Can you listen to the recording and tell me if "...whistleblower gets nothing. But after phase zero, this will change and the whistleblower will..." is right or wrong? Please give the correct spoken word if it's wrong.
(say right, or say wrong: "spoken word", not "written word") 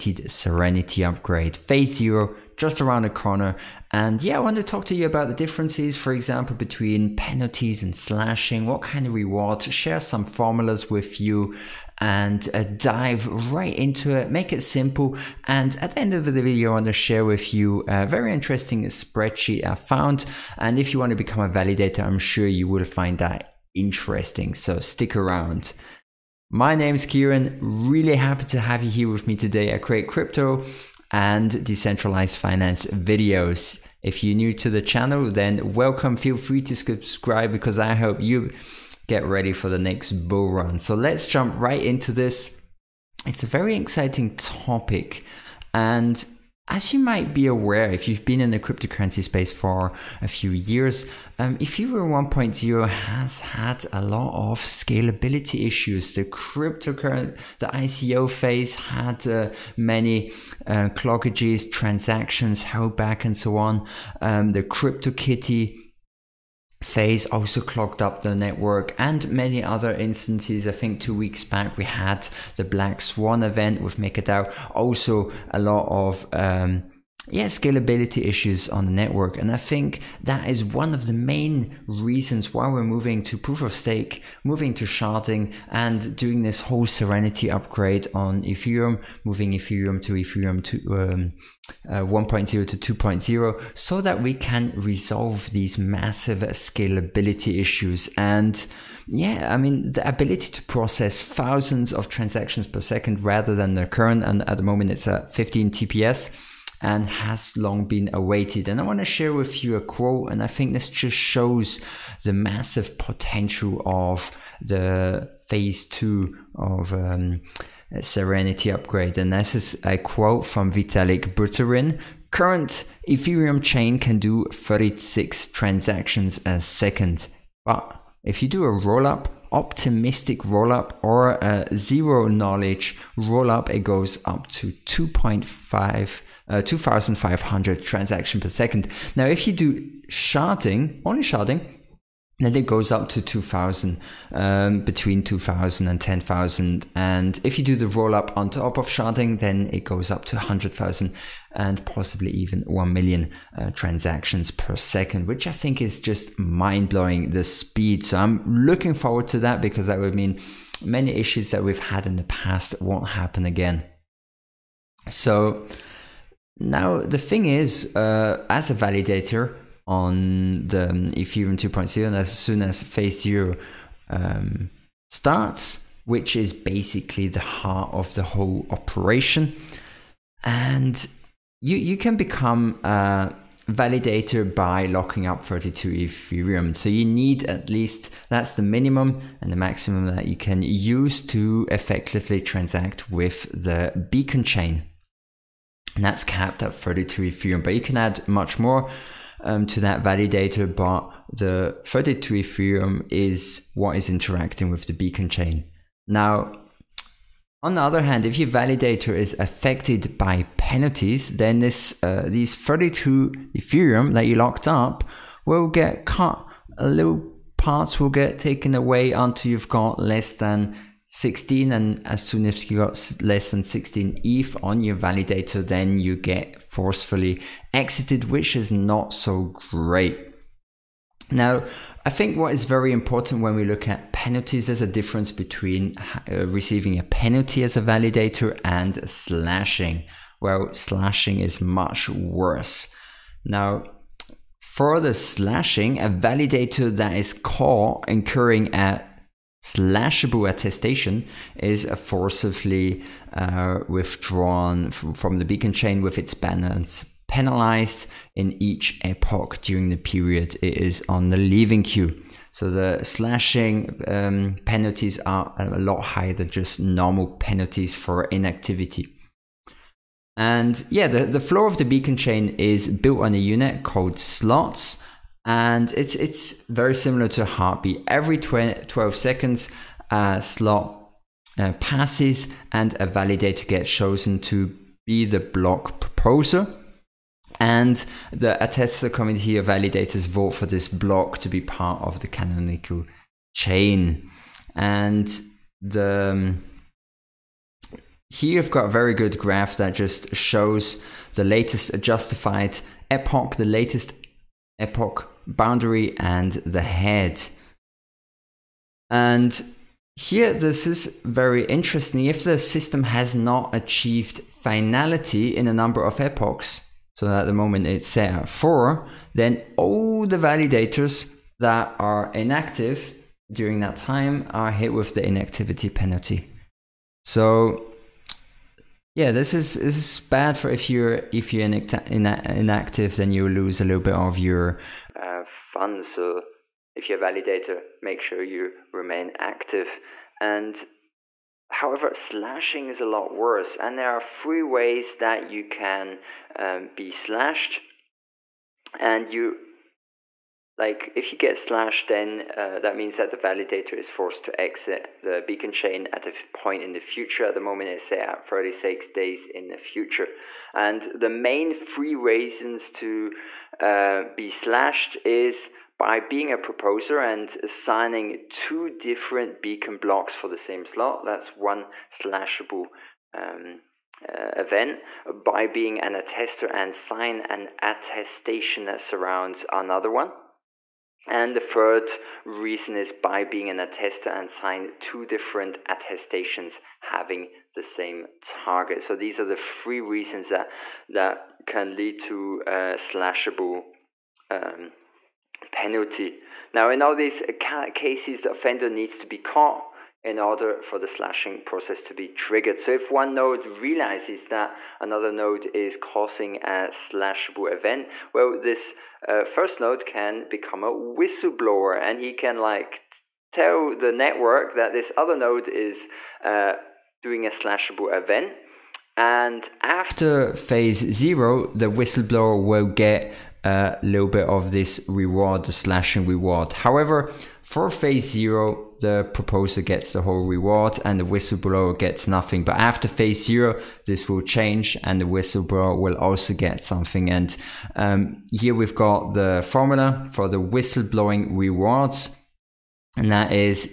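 right.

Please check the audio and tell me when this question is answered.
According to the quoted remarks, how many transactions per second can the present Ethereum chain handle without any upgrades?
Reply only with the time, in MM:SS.
02:04.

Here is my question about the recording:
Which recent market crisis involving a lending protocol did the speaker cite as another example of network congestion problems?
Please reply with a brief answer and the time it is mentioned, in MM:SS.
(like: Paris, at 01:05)
Black Swan event with MakerDAO, at 01:12.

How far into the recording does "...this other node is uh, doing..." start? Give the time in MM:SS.
06:54.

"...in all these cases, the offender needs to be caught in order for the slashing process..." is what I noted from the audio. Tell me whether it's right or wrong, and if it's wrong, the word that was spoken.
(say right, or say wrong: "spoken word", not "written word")
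right.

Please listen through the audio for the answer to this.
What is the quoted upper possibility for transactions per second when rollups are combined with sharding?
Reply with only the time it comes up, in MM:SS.
02:32.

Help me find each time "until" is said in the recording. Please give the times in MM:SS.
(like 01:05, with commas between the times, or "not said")
03:39.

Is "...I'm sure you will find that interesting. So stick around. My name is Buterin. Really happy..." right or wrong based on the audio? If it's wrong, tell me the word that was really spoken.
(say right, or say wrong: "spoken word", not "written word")
wrong: "Kierin", not "Buterin".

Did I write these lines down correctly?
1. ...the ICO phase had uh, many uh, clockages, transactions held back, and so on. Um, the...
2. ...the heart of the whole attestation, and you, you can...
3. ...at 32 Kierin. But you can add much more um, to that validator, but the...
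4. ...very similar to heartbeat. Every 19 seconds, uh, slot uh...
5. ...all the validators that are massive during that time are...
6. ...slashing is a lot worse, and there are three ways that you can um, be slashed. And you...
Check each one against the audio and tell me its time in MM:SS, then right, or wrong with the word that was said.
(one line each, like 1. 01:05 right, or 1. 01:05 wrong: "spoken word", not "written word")
1. 00:57 right
2. 02:57 wrong: "operation", not "attestation"
3. 03:16 wrong: "Ethereum", not "Kierin"
4. 04:36 wrong: "12", not "19"
5. 05:19 wrong: "inactive", not "massive"
6. 05:42 right.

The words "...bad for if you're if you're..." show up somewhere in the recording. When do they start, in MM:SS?
05:30.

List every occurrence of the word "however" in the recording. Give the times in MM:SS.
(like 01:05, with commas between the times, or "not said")
05:41, 07:06.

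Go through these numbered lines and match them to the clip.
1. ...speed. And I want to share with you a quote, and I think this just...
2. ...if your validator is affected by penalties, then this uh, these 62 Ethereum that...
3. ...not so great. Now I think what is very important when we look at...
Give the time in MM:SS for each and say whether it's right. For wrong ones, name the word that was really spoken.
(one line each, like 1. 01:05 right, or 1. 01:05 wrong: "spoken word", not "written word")
1. 01:48 wrong: "awaited", not "speed"
2. 03:28 wrong: "32", not "62"
3. 03:48 right.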